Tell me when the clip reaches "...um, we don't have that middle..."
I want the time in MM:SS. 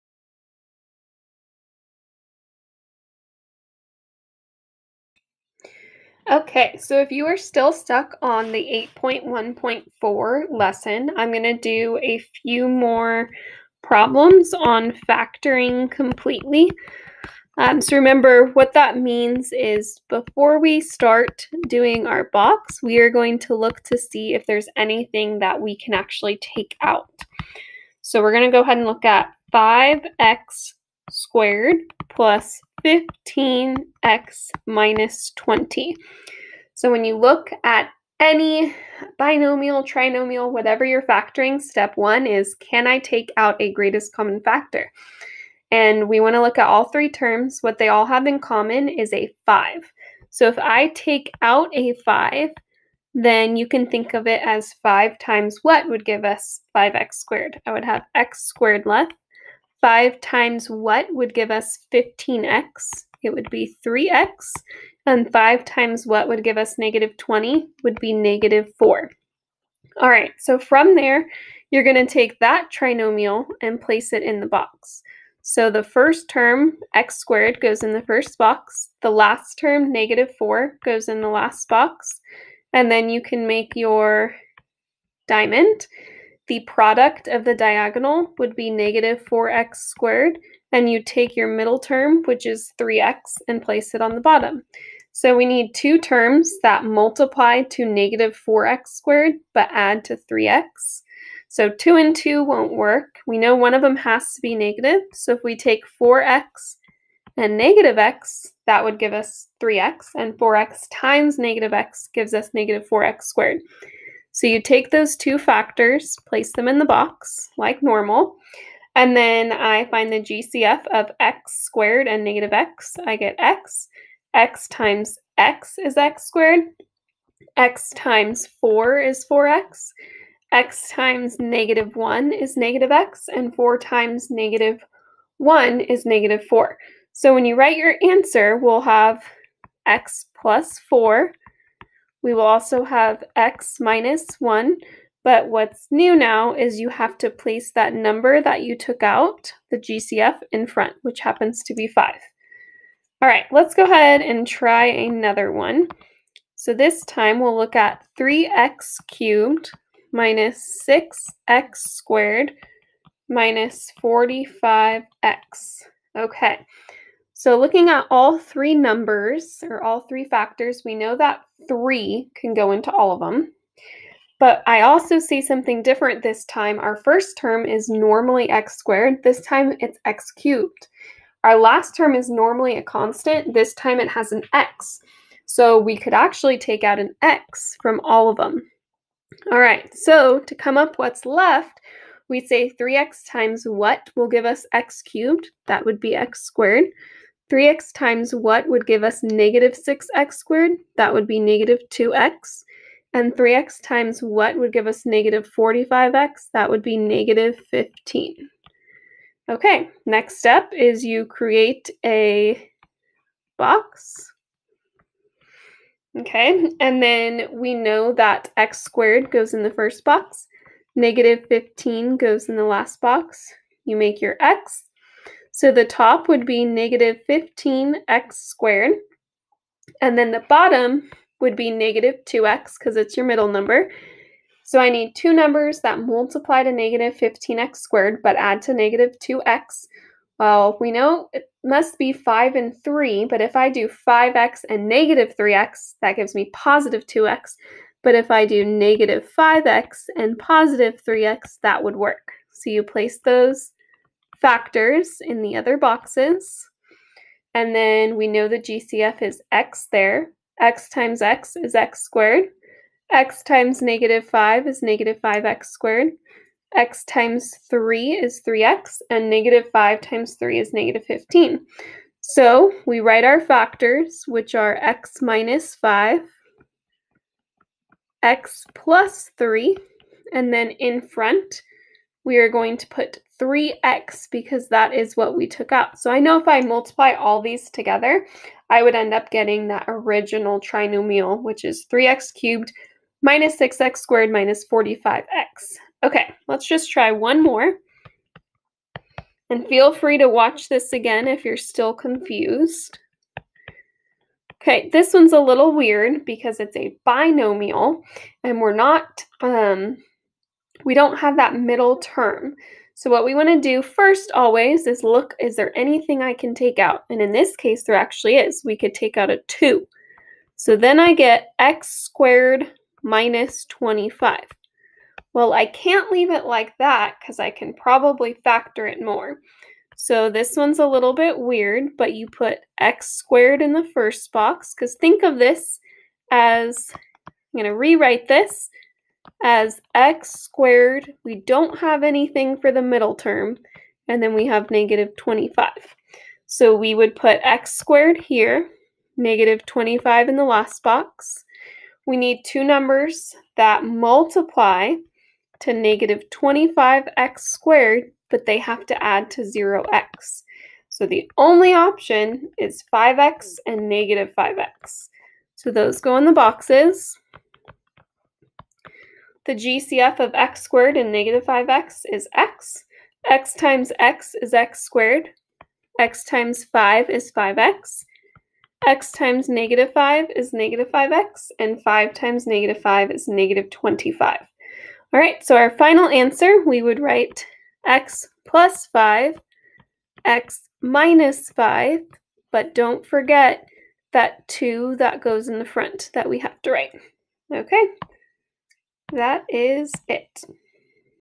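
05:09.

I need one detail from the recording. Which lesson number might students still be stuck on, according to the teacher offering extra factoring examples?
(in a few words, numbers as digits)
8.1.4.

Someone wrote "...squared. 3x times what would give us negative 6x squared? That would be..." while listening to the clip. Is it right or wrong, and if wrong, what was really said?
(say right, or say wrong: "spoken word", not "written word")
right.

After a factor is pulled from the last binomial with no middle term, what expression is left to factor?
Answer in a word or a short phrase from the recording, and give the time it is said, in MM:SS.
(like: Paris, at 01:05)
x^2 - 25, at 05:21.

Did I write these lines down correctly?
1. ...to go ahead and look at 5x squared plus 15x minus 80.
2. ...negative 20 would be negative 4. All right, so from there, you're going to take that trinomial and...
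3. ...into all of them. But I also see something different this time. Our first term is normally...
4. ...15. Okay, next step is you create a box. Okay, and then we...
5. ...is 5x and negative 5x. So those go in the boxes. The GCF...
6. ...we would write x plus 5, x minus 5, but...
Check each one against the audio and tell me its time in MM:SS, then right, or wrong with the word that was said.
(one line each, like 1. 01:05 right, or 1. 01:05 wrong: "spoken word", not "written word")
1. 00:28 wrong: "20", not "80"
2. 01:06 right
3. 02:52 right
4. 03:27 right
5. 06:02 right
6. 06:26 right.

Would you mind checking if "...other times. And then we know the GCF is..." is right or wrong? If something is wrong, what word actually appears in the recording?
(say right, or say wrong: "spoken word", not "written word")
wrong: "boxes", not "times".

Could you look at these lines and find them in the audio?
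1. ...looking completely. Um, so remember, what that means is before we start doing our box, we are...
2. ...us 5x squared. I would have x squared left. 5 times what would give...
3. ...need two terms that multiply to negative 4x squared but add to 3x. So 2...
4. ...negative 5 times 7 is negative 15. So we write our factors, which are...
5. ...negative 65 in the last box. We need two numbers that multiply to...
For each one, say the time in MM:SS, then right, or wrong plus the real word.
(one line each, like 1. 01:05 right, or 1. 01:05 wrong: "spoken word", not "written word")
1. 00:15 wrong: "factoring", not "looking"
2. 00:56 right
3. 01:35 right
4. 04:29 wrong: "3", not "7"
5. 05:49 wrong: "25", not "65".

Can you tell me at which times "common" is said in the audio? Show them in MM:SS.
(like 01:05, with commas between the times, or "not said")
00:44, 00:48.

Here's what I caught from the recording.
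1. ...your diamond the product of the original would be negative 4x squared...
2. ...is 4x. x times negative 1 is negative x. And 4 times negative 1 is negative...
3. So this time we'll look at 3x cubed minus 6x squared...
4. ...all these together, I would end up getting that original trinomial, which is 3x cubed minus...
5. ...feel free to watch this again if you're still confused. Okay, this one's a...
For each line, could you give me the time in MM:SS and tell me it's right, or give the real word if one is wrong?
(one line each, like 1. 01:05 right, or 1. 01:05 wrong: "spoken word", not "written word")
1. 01:23 wrong: "diagonal", not "original"
2. 02:09 right
3. 02:36 right
4. 04:47 right
5. 04:59 right.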